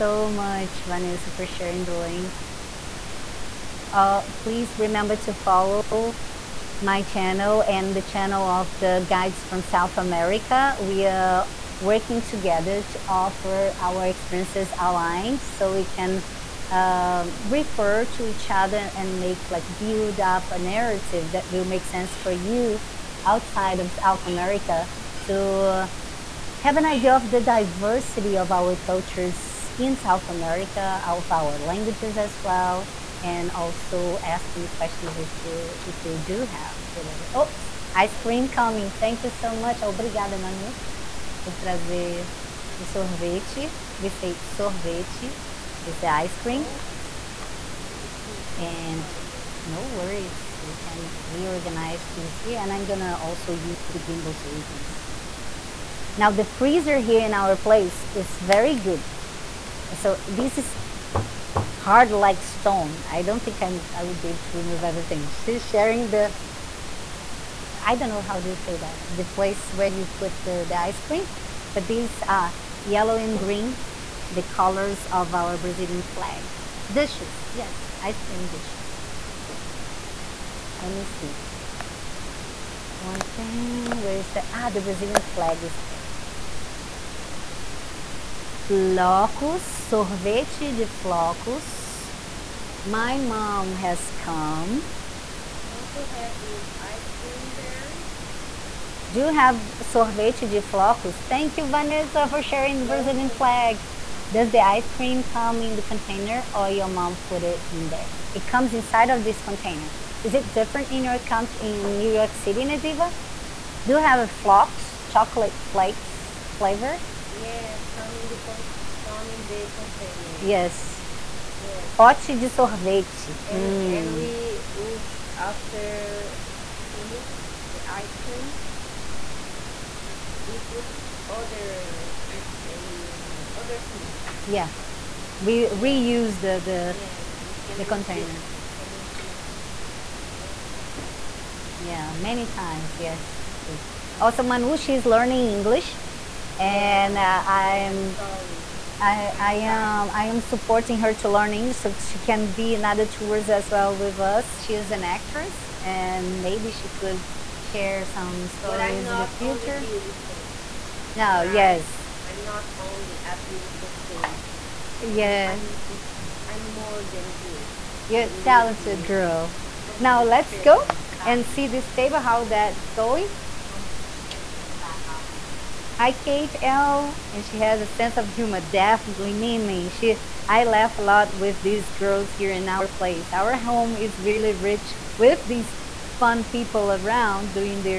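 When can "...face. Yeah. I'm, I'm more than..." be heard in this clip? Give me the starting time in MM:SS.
02:44.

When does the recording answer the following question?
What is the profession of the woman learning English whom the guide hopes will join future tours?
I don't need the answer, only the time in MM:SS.
02:34.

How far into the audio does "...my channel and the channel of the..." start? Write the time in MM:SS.
00:06.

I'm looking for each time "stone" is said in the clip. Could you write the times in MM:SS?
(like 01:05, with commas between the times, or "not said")
01:02.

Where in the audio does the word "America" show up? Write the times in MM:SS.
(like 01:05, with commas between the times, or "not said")
00:09, 00:24, 00:30.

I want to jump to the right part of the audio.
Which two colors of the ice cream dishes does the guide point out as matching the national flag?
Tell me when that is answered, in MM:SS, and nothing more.
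01:12.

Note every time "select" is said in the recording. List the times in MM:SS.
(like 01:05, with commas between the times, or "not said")
not said.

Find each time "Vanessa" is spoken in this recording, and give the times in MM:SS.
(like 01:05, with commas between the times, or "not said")
00:00, 01:41.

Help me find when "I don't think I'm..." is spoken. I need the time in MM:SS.
01:03.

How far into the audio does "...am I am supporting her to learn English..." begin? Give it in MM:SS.
02:29.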